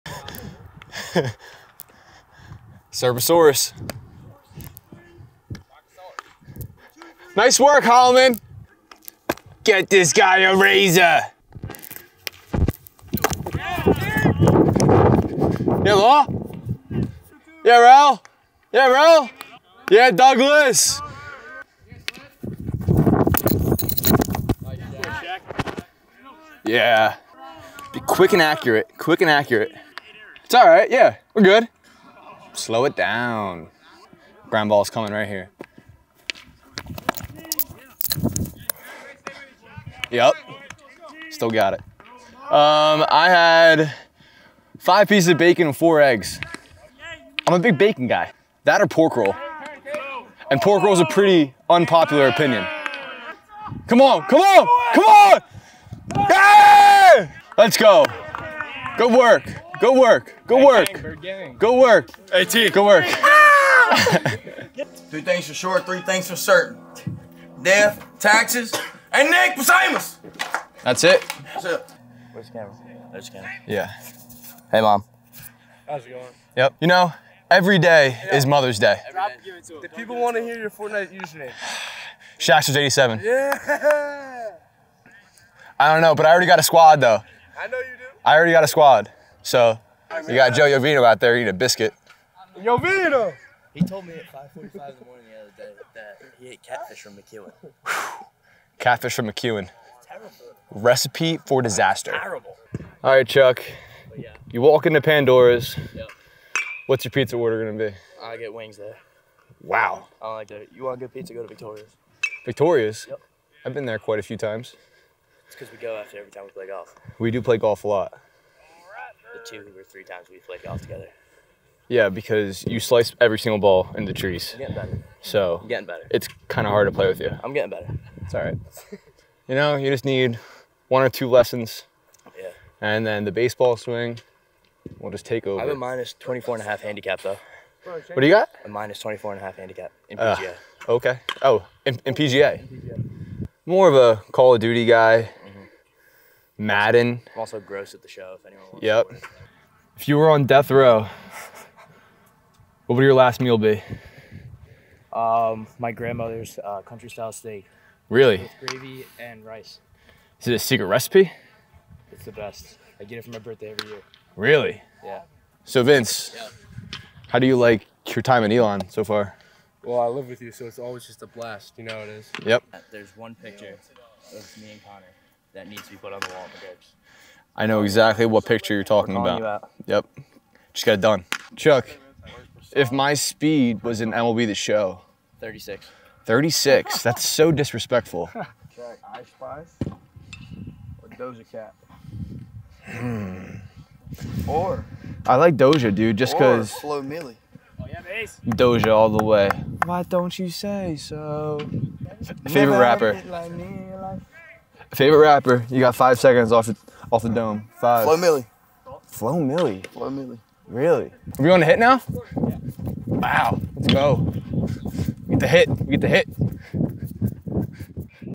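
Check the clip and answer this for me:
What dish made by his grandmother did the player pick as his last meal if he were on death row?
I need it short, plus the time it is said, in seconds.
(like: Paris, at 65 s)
Country style steak, at 156 s.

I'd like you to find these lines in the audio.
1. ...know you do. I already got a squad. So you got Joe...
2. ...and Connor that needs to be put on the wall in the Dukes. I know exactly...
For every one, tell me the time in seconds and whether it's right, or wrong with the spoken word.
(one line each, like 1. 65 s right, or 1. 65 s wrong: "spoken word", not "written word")
1. 87 s right
2. 174 s right.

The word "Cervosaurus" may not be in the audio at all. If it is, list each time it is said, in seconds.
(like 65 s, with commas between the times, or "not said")
2 s.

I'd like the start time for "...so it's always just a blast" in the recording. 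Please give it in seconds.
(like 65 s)
170 s.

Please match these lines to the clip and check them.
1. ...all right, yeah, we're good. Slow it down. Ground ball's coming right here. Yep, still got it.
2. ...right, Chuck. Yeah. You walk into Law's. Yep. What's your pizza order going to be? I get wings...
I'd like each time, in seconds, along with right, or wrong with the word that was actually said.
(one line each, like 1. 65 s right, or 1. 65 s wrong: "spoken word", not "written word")
1. 30 s right
2. 103 s wrong: "Pandora", not "Law".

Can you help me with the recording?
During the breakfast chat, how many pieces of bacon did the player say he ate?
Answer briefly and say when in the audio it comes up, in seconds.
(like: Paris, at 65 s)
5, at 44 s.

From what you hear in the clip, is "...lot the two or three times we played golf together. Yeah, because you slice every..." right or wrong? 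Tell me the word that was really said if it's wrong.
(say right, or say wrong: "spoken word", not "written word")
right.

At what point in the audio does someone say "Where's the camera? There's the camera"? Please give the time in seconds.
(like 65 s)
72 s.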